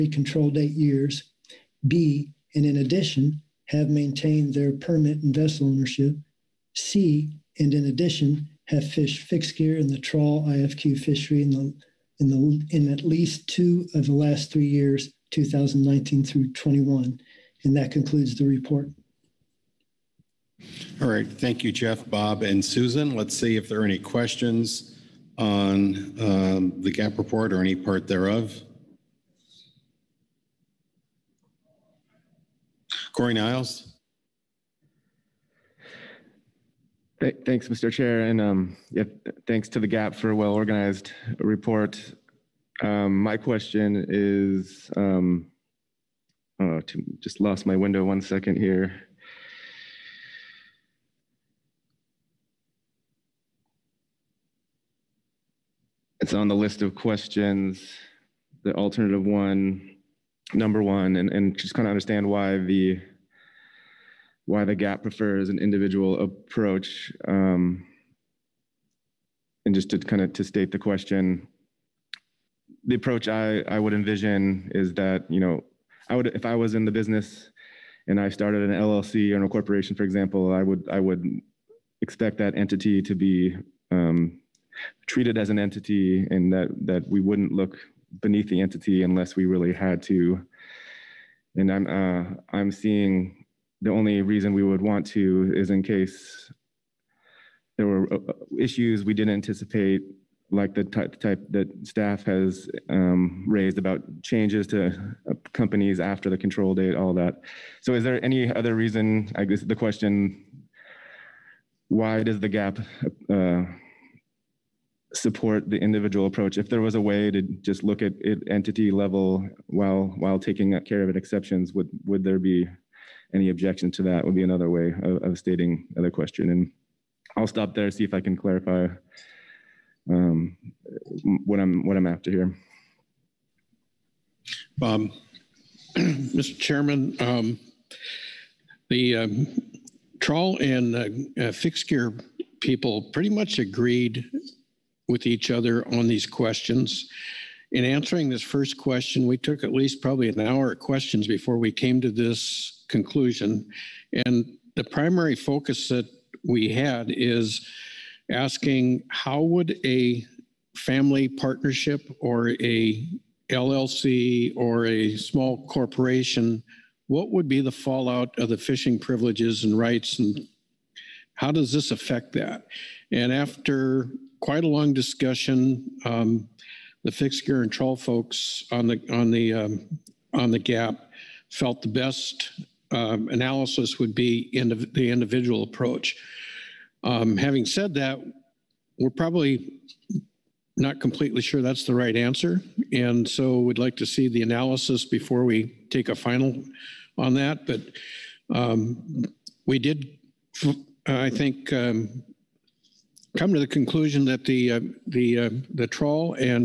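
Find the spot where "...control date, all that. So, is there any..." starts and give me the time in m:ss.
1:46.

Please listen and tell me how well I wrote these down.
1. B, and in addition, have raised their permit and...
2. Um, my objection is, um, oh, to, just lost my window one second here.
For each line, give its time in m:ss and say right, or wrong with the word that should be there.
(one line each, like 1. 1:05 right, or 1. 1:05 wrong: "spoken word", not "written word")
1. 0:01 wrong: "maintained", not "raised"
2. 0:42 wrong: "question", not "objection".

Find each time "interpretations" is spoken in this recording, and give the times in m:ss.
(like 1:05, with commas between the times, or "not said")
not said.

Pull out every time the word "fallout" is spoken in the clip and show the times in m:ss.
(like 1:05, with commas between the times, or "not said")
2:47.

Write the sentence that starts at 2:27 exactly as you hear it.
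In answering this first question, we took at least probably an hour of questions before we came to this conclusion.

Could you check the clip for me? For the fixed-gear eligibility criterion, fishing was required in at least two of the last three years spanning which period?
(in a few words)
2019 through 2021.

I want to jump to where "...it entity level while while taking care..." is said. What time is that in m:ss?
1:58.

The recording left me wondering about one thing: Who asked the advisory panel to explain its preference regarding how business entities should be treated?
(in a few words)
Corey Niles.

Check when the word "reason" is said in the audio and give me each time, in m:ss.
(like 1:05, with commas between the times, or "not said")
1:34, 1:48.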